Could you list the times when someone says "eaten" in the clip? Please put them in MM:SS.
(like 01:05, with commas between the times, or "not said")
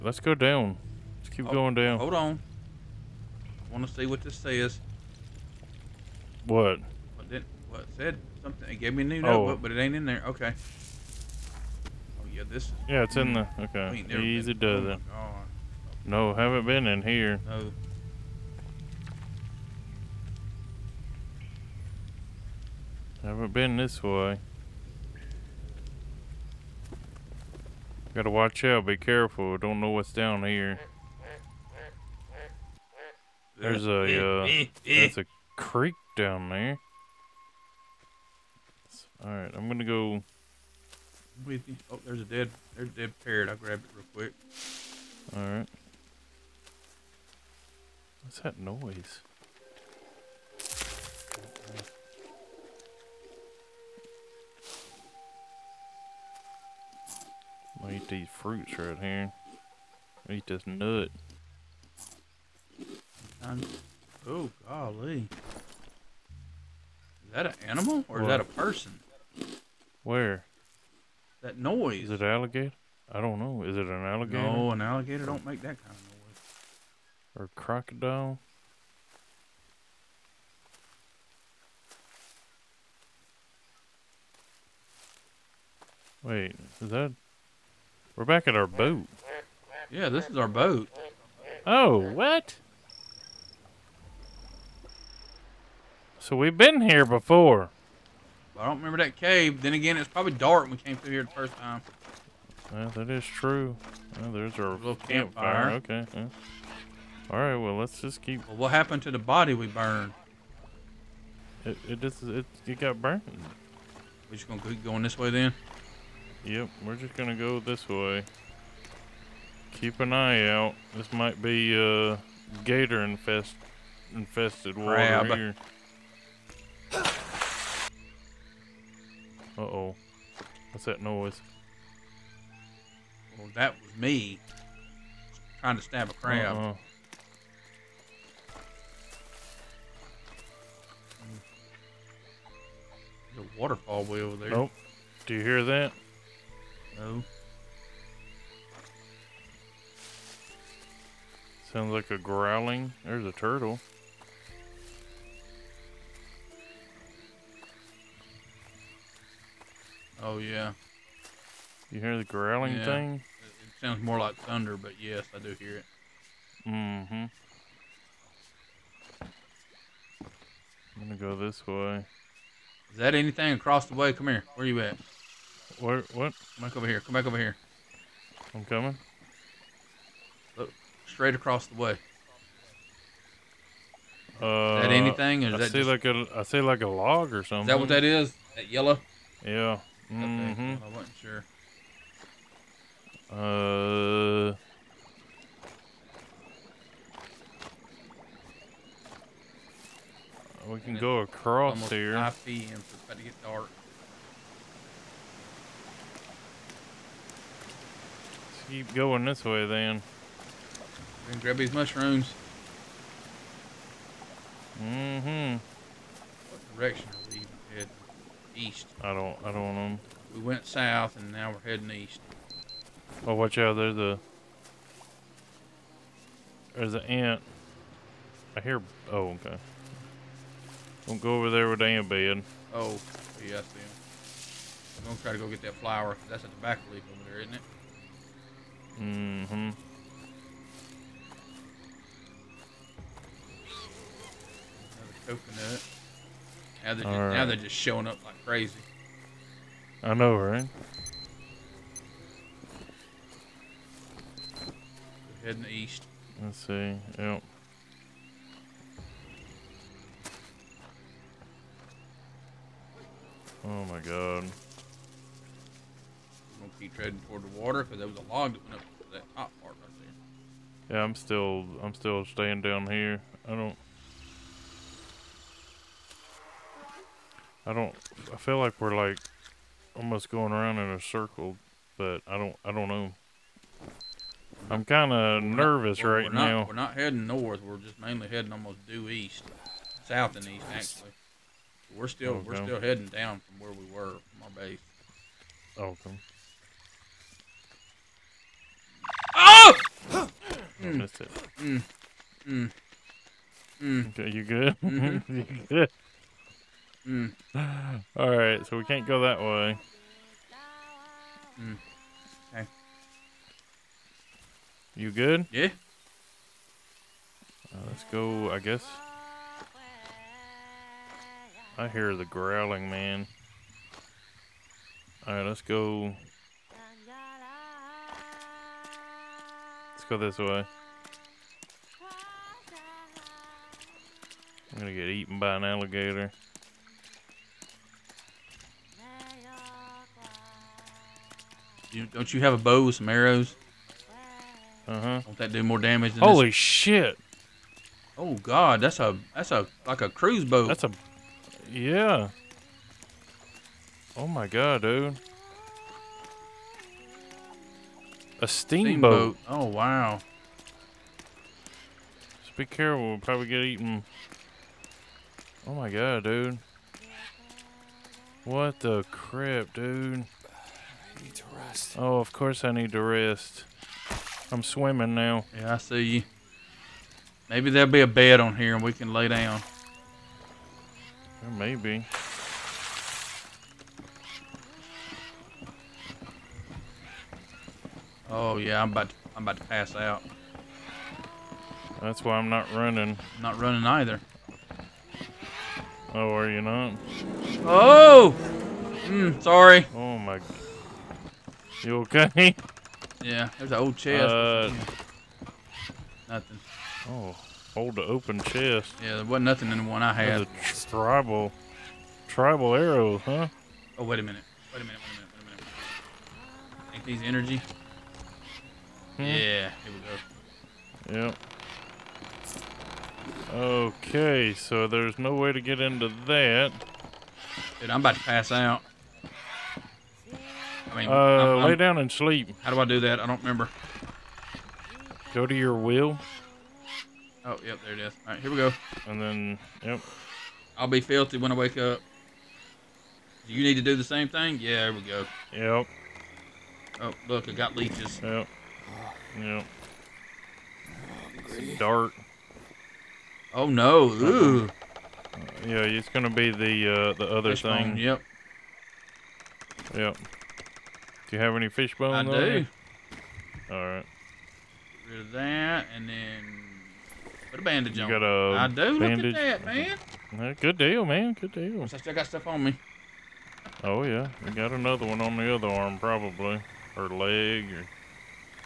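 05:35, 06:03.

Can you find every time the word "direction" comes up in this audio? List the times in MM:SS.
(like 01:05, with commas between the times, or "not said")
03:36.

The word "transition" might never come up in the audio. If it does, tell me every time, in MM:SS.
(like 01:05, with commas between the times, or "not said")
not said.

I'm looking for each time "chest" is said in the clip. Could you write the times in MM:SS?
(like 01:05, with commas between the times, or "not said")
06:43, 06:48.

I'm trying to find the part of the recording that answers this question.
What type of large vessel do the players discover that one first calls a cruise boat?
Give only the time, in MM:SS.
05:58.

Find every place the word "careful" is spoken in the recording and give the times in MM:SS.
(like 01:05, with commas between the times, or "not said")
00:28, 06:02.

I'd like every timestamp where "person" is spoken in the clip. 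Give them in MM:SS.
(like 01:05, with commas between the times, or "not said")
01:08.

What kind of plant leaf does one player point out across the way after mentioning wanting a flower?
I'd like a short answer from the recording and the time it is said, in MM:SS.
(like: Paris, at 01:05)
Tobacco leaf, at 03:56.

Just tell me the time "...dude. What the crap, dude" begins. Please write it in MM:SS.
06:06.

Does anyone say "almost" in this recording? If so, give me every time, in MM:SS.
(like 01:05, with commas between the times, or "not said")
04:39, 04:48.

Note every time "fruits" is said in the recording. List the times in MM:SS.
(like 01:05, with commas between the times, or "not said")
00:58.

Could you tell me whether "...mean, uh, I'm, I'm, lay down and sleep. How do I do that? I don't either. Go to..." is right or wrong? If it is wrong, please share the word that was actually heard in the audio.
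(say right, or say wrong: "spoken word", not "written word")
wrong: "remember", not "either".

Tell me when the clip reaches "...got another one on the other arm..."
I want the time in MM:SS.
07:54.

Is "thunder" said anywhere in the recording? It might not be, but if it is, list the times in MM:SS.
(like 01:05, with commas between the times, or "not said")
02:44.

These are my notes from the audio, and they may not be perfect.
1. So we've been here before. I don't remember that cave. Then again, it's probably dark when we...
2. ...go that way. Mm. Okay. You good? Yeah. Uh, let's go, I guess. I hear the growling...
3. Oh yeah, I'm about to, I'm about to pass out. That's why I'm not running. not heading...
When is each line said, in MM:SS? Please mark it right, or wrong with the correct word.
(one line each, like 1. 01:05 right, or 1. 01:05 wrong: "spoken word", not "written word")
1. 01:36 right
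2. 05:09 right
3. 06:28 wrong: "running", not "heading".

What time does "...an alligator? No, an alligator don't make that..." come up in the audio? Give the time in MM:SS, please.
01:13.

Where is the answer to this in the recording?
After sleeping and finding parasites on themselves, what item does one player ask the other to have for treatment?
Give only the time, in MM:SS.
07:41.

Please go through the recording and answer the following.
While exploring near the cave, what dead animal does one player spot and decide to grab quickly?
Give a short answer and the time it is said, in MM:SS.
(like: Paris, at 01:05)
Parrot, at 00:42.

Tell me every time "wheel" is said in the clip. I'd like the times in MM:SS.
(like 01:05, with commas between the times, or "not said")
07:15.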